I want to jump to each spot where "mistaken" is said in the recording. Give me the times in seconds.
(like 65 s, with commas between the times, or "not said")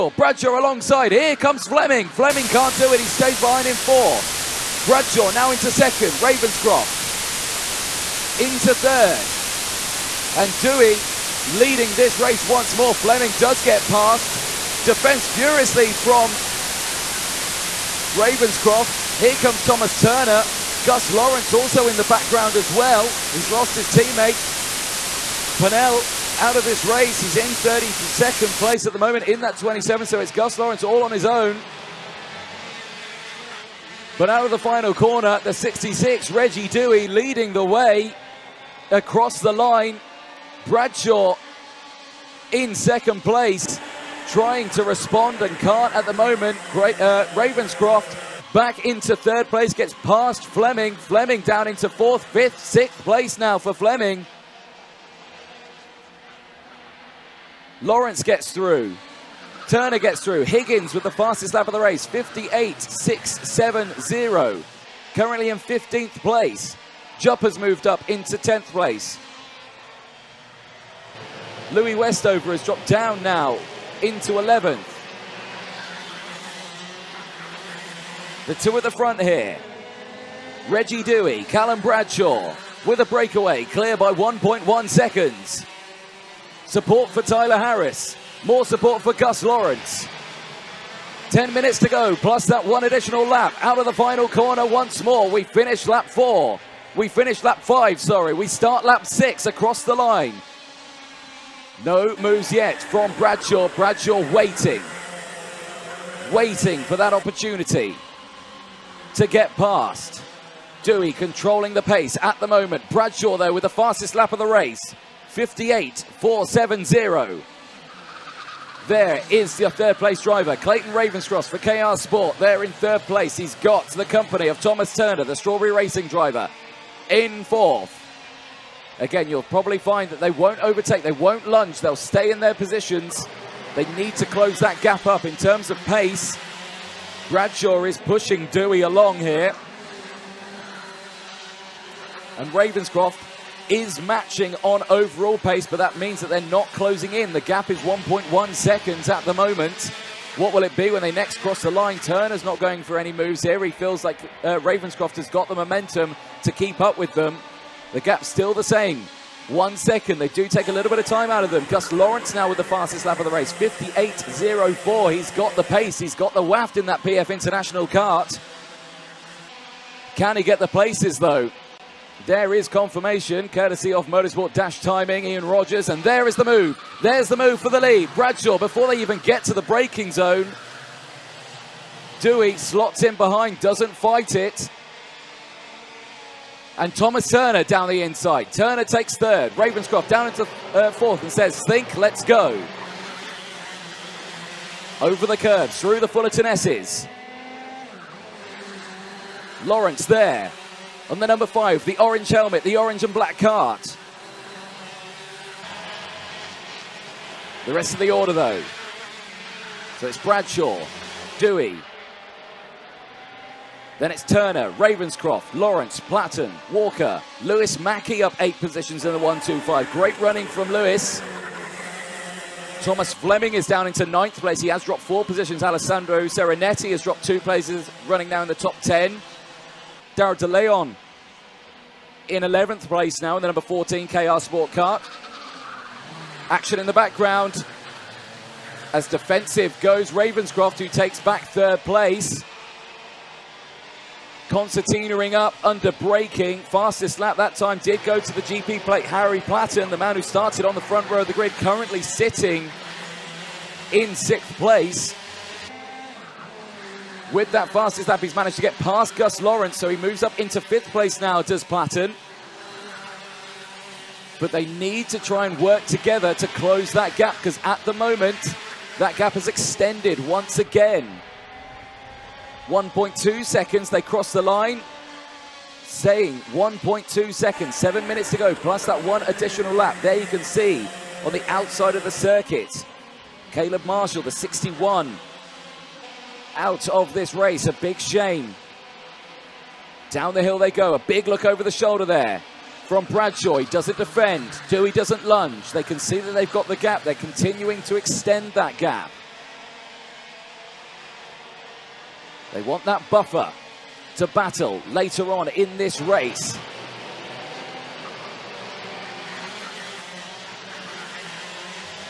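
not said.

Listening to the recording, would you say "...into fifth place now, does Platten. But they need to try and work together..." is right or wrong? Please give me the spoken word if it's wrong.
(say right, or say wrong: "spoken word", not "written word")
right.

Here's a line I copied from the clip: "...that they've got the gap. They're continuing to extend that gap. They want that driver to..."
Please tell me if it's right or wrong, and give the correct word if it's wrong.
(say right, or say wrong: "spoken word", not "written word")
wrong: "buffer", not "driver".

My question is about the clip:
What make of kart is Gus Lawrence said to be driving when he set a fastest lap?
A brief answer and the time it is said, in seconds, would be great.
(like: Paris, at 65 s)
PF International, at 167 s.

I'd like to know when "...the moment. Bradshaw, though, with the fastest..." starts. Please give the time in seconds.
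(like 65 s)
112 s.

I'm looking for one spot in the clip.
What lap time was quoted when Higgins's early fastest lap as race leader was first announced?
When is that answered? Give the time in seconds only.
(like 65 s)
62 s.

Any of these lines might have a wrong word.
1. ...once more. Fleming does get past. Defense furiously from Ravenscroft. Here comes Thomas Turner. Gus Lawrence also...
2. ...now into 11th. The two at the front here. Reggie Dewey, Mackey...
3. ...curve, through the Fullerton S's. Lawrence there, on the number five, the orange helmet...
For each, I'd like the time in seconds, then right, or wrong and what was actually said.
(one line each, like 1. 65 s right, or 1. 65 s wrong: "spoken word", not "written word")
1. 12 s right
2. 73 s wrong: "Callum", not "Mackey"
3. 195 s right.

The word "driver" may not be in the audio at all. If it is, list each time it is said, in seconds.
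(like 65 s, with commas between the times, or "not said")
120 s, 126 s.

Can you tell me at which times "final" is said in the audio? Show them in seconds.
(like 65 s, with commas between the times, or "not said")
34 s, 93 s.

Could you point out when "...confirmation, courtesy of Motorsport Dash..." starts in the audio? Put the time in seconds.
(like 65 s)
172 s.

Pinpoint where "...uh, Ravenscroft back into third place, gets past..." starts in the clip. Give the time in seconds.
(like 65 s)
47 s.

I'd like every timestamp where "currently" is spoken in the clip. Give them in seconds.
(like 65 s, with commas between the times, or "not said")
65 s, 251 s.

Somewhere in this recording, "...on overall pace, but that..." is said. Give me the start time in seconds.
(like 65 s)
144 s.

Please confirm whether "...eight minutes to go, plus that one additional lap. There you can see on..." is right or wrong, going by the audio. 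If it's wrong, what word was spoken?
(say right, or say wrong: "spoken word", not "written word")
wrong: "seven", not "eight".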